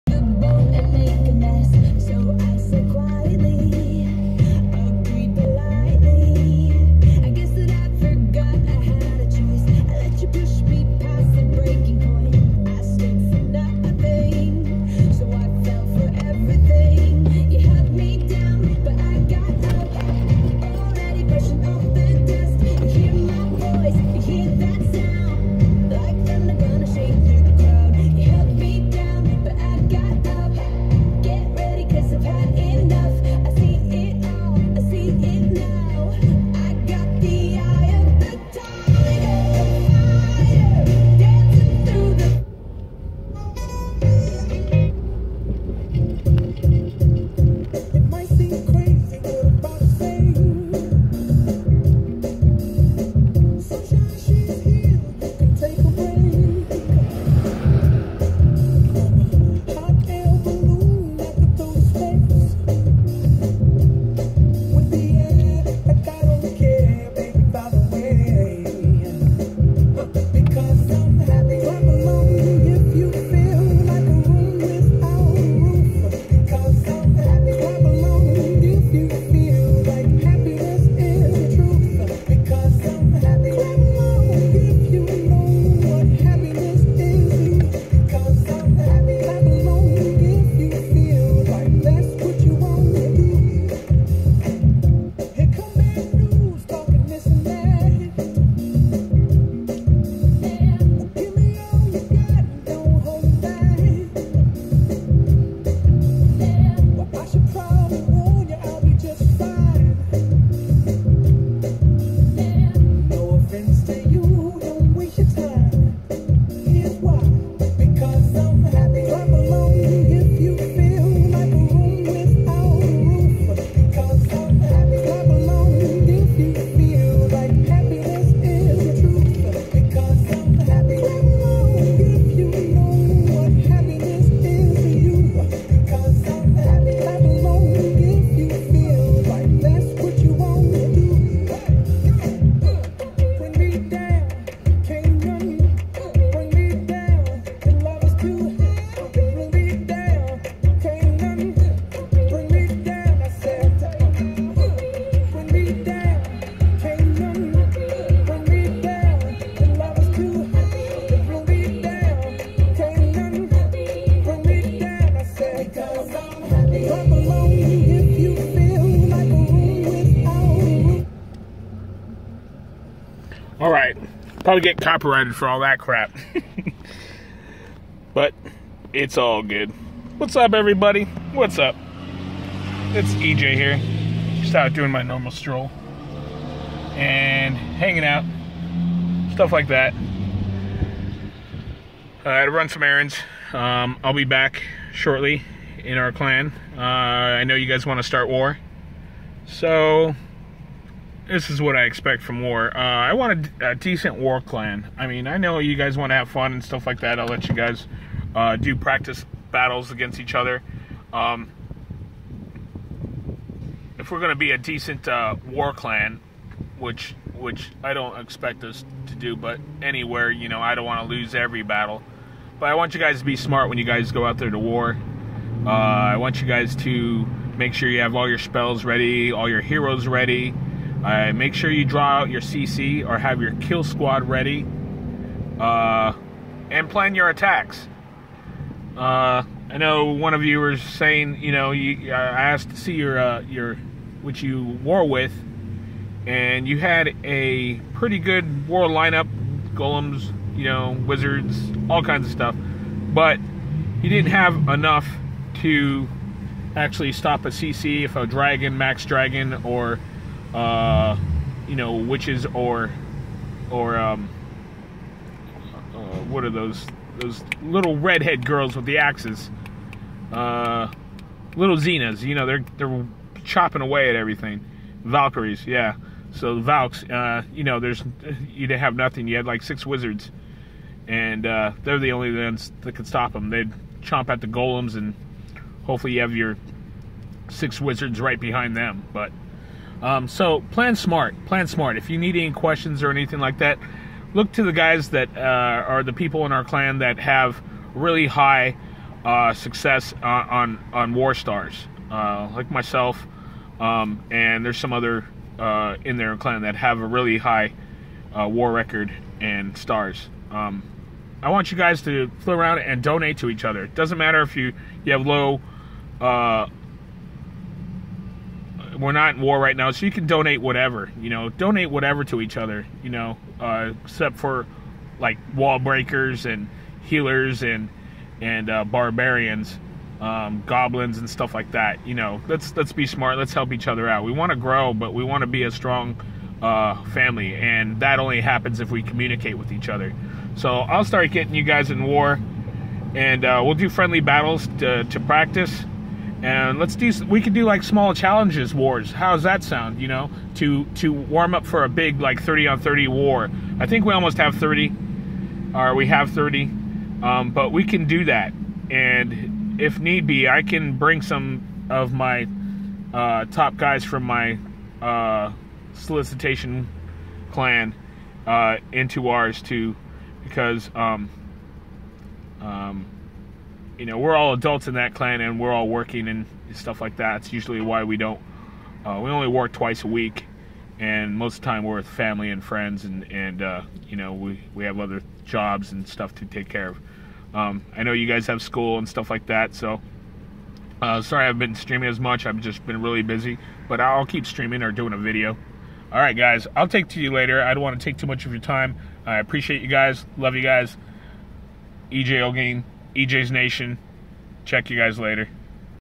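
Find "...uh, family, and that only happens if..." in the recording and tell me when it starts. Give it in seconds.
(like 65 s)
336 s.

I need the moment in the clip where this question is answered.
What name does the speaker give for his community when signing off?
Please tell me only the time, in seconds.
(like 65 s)
403 s.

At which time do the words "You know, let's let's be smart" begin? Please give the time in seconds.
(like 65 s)
332 s.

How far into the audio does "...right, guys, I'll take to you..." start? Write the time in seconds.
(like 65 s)
396 s.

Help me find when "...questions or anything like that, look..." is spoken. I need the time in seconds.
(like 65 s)
292 s.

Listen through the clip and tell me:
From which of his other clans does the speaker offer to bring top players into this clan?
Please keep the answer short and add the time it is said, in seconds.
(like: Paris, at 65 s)
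solicitation clan, at 365 s.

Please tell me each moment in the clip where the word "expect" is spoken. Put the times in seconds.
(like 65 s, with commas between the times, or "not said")
201 s, 218 s.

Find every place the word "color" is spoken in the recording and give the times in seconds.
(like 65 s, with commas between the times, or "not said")
not said.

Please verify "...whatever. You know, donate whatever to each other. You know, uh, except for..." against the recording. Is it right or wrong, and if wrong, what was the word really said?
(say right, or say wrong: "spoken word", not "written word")
right.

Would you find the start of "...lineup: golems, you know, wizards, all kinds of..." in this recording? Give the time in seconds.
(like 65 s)
248 s.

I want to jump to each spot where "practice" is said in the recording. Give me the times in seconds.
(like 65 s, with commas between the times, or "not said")
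208 s, 345 s.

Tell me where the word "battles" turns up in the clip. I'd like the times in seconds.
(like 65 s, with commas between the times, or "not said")
209 s, 221 s, 344 s.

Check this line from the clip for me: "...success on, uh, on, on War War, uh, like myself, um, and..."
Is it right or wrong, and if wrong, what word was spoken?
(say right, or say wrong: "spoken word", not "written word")
wrong: "Stars", not "War".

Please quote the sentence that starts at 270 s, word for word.
Uh, little Xenas, you know, they're they're chopping away at everything.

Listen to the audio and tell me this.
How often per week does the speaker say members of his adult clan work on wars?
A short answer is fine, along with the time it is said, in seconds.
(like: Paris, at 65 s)
twice a week, at 379 s.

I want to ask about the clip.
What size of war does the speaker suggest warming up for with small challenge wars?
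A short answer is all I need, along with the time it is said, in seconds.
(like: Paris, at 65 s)
30 on 30, at 352 s.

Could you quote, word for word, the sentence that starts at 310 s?
Um, I want you guys to fly around and donate to each other.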